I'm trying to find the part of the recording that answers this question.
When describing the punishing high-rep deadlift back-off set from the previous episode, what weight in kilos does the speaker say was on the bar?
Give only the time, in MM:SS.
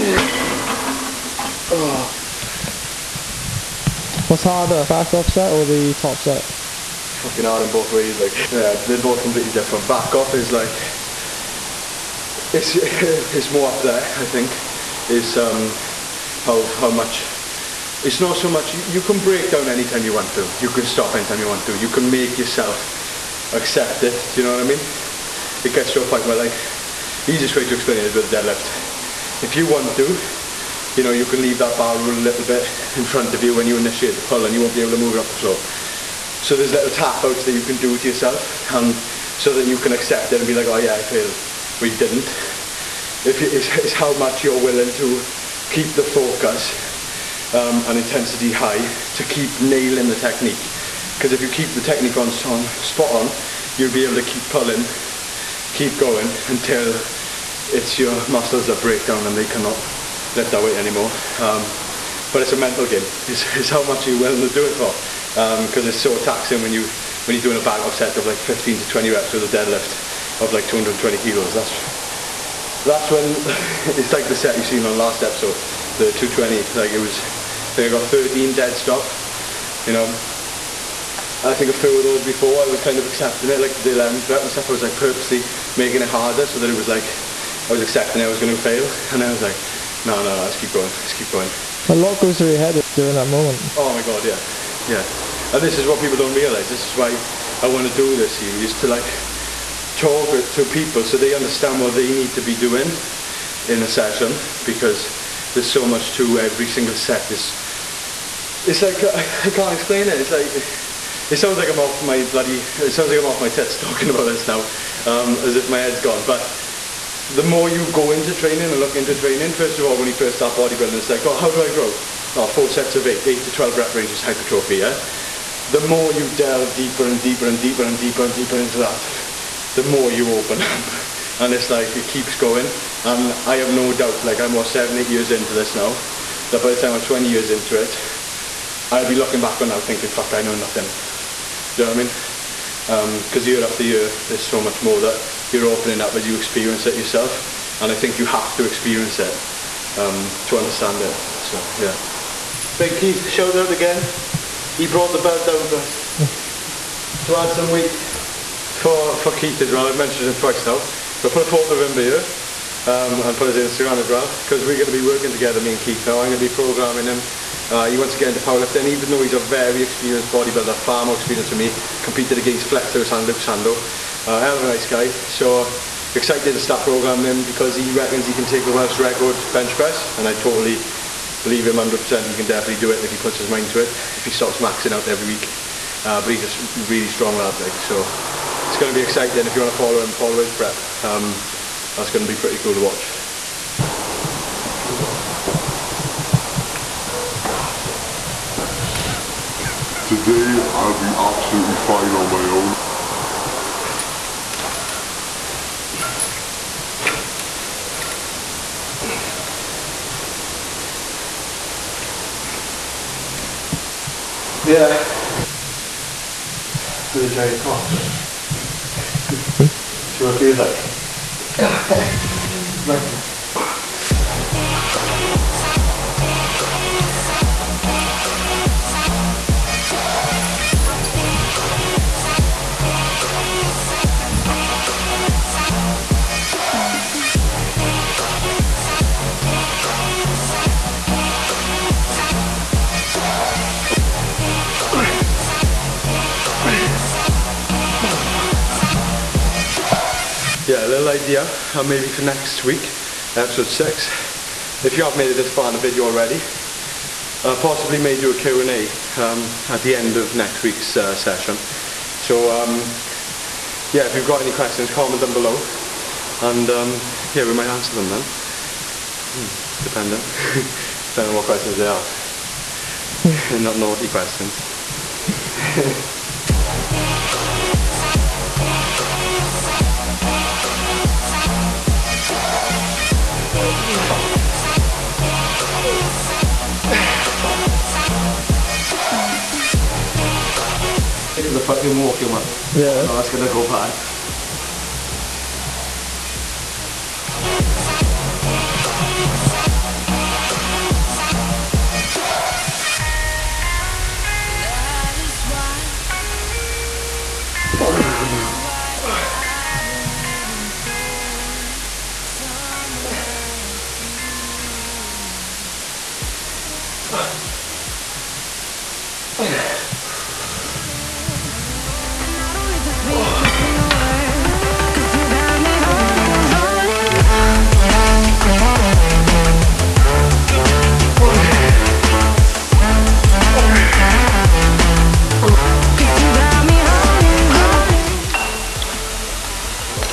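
01:10.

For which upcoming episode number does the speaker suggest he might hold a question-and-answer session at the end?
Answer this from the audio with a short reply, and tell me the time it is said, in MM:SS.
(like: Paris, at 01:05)
6, at 04:13.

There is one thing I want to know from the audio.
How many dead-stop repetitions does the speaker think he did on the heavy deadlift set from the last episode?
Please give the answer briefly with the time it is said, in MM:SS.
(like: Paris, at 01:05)
13, at 01:18.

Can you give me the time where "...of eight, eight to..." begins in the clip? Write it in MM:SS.
02:02.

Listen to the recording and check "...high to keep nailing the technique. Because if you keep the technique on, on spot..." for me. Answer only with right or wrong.
right.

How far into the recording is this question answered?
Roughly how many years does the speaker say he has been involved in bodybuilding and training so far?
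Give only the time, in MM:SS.
02:14.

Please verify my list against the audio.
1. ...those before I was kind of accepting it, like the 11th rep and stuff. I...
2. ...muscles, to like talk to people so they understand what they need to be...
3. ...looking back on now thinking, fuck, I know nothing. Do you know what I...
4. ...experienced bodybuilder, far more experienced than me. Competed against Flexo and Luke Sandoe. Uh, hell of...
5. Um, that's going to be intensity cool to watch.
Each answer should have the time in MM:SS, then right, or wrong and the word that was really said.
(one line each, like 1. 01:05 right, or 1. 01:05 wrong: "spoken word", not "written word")
1. 01:22 right
2. 01:38 wrong: "series", not "muscles"
3. 02:19 right
4. 02:49 right
5. 03:11 wrong: "pretty", not "intensity".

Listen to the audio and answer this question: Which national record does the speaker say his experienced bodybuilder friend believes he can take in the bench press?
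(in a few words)
Welsh record.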